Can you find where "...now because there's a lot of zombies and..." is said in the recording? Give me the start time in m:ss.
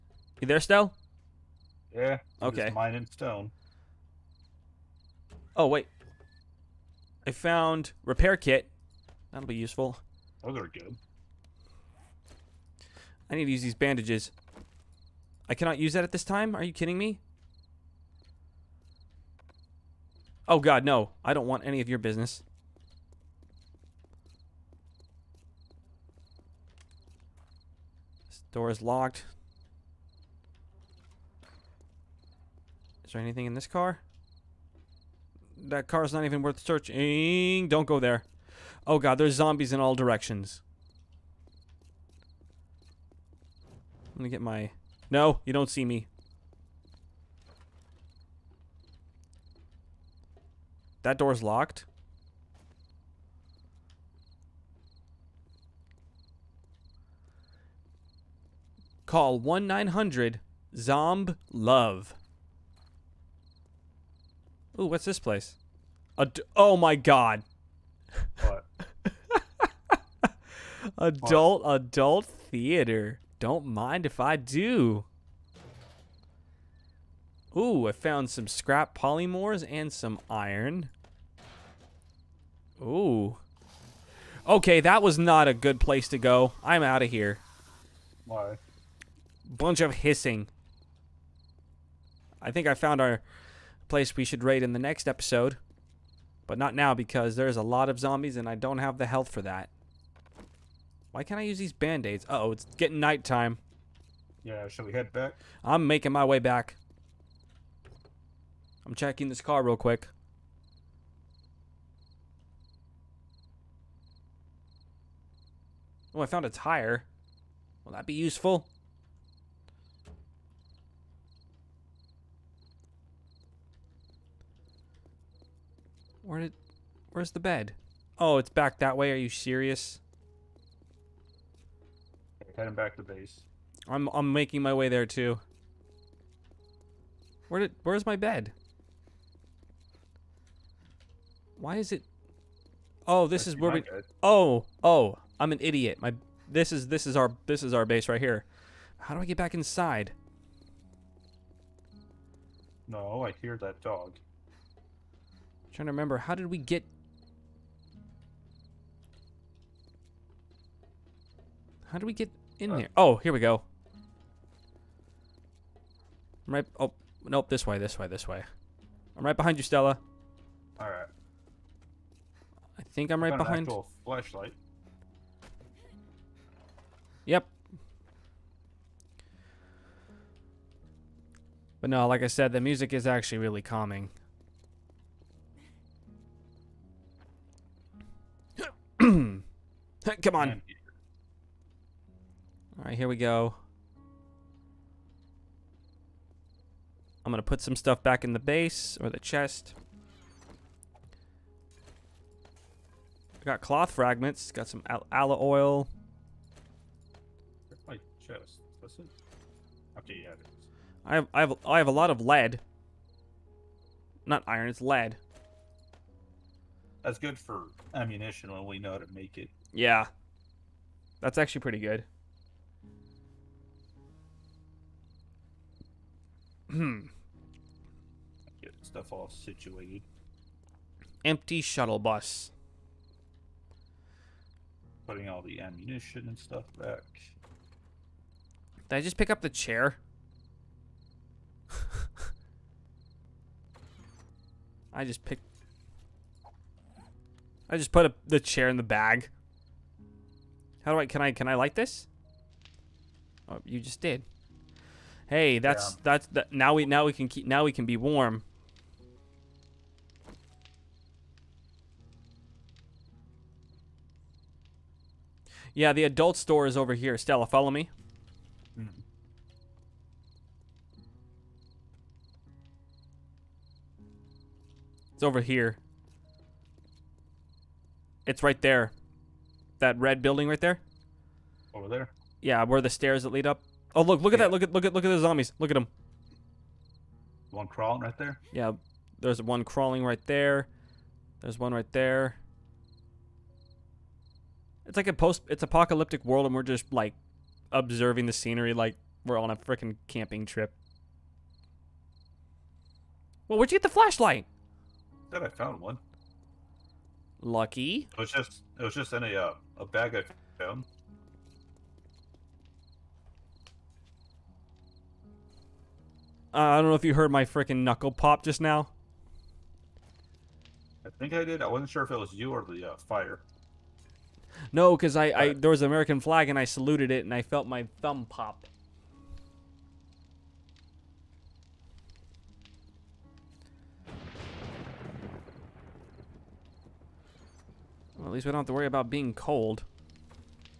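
1:36.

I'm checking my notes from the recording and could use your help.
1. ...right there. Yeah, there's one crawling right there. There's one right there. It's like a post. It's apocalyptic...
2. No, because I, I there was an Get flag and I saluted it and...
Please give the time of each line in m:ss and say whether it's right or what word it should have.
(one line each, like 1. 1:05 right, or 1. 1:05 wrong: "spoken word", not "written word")
1. 4:48 right
2. 5:24 wrong: "American", not "Get".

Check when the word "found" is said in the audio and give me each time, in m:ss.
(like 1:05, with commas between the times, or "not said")
0:07, 1:17, 1:32, 1:56, 5:05.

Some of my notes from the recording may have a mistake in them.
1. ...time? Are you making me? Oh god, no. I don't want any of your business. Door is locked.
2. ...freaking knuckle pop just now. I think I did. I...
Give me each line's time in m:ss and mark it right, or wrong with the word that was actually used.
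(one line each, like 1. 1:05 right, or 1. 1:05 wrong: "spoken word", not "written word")
1. 0:16 wrong: "kidding", not "making"
2. 5:17 right.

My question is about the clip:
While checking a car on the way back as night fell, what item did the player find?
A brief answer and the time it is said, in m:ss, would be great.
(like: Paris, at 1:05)
A tire, at 1:56.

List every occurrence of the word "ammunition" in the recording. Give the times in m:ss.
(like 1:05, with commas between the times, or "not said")
3:37, 3:55.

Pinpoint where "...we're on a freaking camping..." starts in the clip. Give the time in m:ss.
4:59.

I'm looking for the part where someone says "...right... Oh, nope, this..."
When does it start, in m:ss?
2:46.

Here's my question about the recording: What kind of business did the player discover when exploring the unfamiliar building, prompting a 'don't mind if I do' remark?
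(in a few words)
Adult theater.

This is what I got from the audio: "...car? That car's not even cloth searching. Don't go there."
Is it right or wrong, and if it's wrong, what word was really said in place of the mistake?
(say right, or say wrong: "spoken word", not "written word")
wrong: "worth", not "cloth".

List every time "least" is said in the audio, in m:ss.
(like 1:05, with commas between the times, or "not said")
5:38.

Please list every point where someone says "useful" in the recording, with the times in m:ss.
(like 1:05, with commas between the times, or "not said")
0:09, 1:58.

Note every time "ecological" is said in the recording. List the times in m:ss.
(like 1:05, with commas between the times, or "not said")
not said.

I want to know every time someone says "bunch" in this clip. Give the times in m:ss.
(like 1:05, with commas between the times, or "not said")
1:29.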